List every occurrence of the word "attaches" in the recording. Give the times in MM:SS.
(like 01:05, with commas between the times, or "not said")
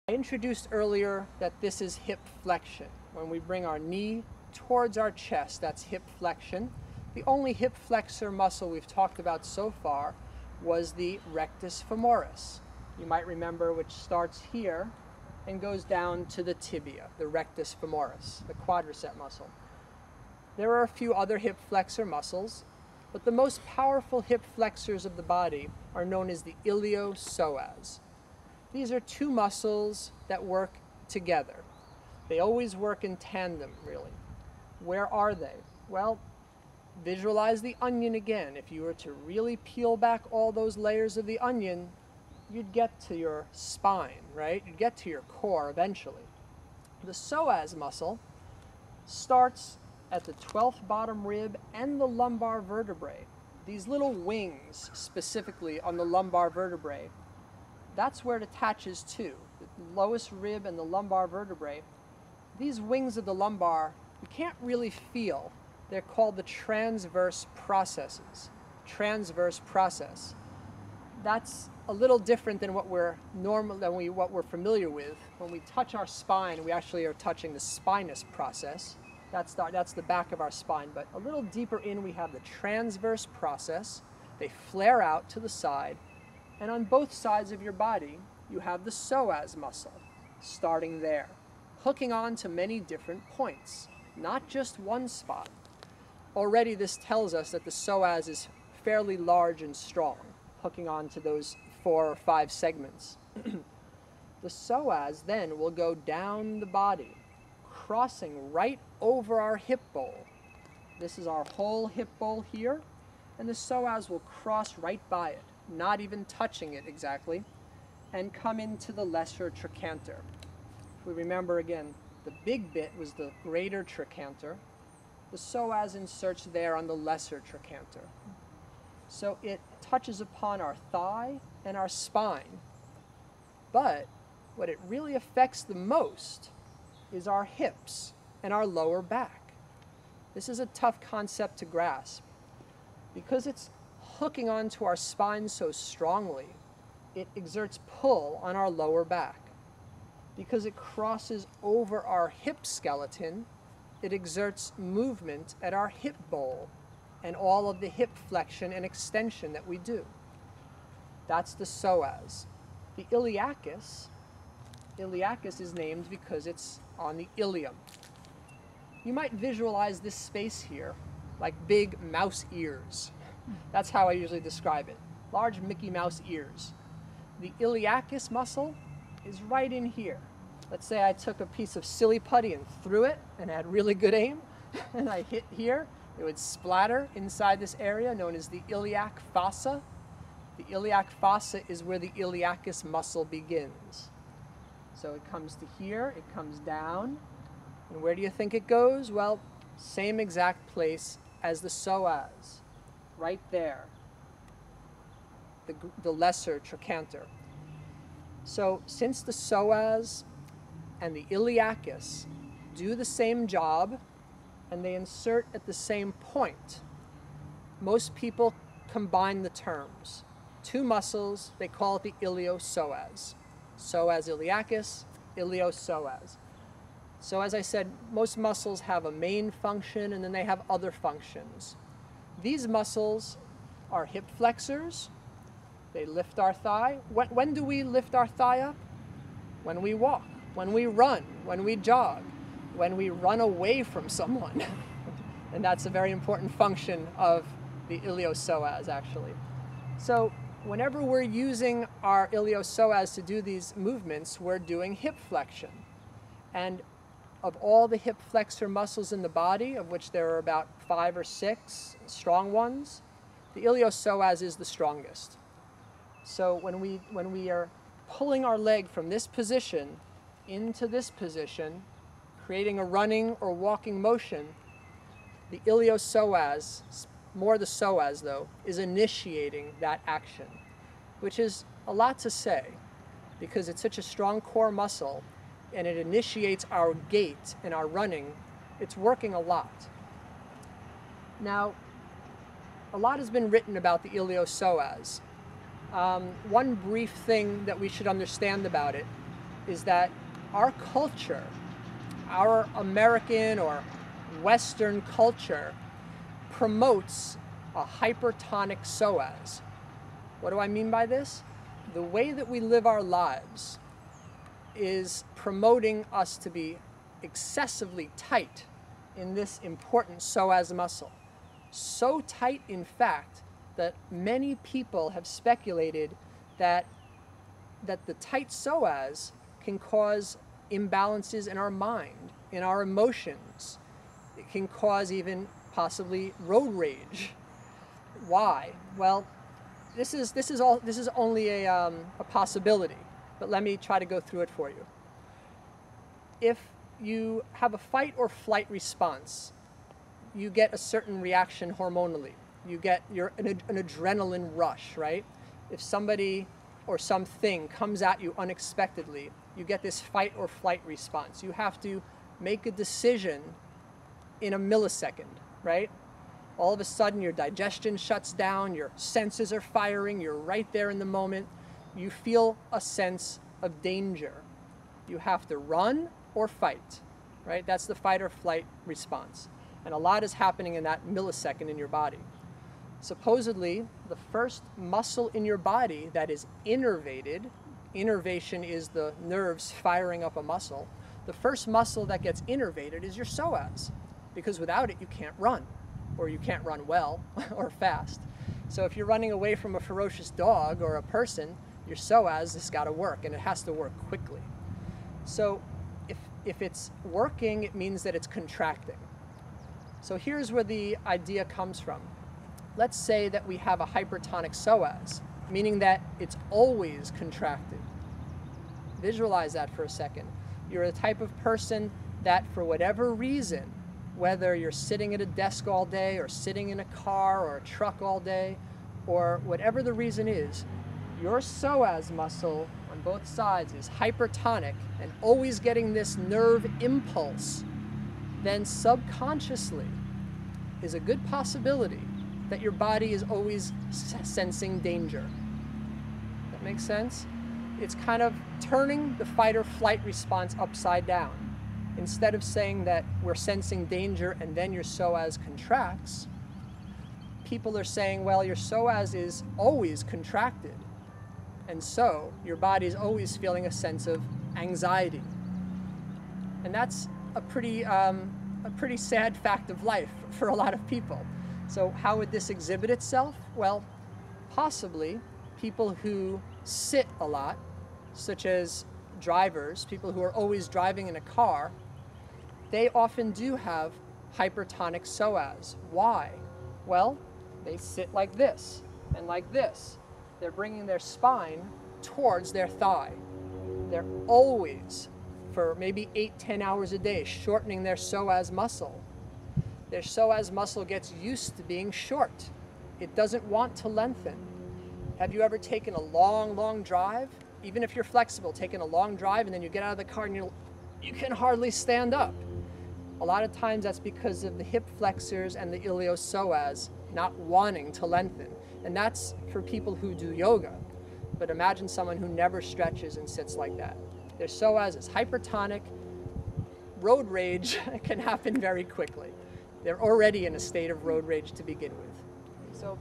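00:58.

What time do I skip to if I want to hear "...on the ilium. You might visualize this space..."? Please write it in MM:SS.
02:46.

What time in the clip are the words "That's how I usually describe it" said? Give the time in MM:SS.
02:53.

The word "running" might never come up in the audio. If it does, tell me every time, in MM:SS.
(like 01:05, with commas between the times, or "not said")
04:32, 04:47, 06:39.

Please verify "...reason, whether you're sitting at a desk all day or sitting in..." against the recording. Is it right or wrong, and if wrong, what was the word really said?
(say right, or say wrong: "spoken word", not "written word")
right.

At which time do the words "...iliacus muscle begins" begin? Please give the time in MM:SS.
03:12.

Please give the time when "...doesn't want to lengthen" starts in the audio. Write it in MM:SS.
08:23.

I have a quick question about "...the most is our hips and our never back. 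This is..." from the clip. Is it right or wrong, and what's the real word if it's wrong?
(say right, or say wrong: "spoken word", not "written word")
wrong: "lower", not "never".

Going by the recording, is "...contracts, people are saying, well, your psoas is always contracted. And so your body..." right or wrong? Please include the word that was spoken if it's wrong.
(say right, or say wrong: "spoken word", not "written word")
right.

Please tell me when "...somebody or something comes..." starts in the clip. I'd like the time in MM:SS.
05:55.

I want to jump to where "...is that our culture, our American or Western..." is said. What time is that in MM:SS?
04:59.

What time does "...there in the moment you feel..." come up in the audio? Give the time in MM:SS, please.
06:10.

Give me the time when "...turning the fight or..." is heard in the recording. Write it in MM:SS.
07:28.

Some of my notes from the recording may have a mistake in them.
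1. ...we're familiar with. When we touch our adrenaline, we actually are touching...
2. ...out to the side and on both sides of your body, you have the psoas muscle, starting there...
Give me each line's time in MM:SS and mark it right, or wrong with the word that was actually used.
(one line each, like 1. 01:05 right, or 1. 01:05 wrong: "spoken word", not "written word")
1. 01:14 wrong: "spine", not "adrenaline"
2. 01:25 right.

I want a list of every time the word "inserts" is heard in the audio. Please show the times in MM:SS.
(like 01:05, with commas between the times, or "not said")
02:05, 03:34.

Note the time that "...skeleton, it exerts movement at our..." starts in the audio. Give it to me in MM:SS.
02:32.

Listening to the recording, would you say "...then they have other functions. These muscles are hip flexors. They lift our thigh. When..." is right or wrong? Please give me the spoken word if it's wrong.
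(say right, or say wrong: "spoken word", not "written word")
right.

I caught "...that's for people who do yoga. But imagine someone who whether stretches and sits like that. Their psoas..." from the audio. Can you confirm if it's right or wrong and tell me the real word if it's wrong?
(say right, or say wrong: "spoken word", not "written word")
wrong: "never", not "whether".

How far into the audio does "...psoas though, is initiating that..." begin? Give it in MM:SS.
04:37.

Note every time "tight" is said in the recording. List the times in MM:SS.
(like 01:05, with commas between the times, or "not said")
05:18, 05:22, 05:28.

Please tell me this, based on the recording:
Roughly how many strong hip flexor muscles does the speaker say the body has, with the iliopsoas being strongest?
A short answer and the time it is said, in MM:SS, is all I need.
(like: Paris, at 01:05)
5 or 6, at 04:20.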